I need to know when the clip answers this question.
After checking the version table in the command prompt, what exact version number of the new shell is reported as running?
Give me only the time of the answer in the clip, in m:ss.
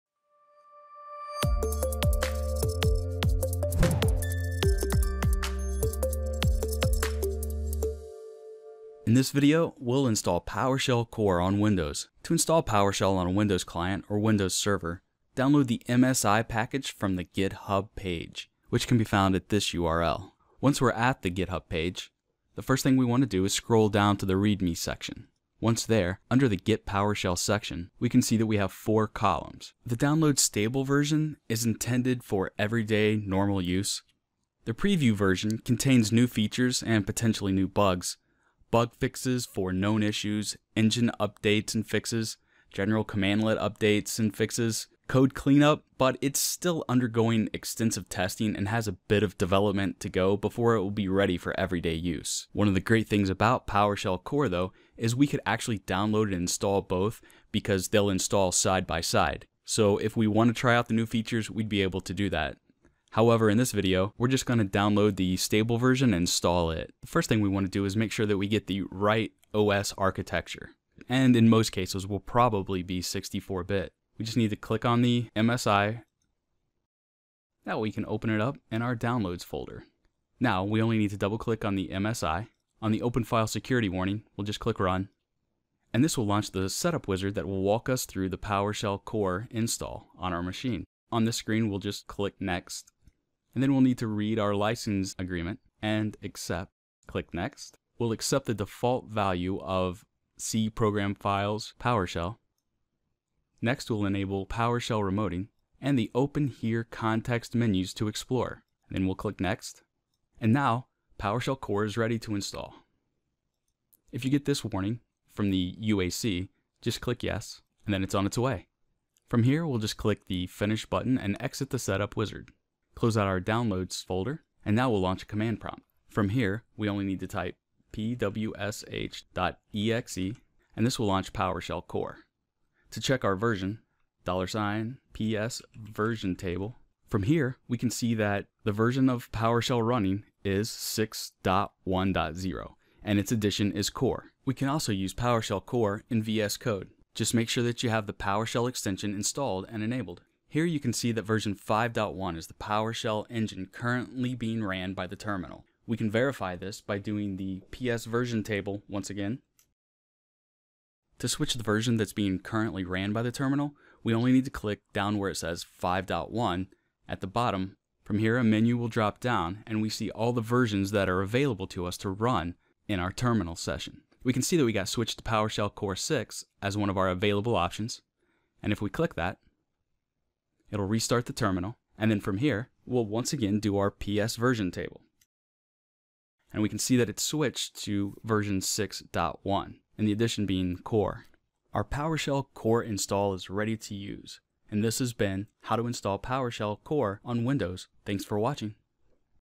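2:20.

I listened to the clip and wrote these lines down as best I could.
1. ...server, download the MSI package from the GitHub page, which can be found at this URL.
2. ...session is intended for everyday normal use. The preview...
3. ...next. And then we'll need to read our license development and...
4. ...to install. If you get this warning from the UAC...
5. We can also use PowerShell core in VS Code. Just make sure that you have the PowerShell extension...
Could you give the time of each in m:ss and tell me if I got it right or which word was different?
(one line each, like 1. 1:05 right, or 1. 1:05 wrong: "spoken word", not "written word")
1. 0:14 right
2. 0:30 wrong: "version", not "session"
3. 1:32 wrong: "agreement", not "development"
4. 1:52 right
5. 2:24 right.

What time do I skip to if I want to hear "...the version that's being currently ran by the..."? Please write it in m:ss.
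2:41.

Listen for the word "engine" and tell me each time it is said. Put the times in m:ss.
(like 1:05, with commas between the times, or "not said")
0:40, 2:33.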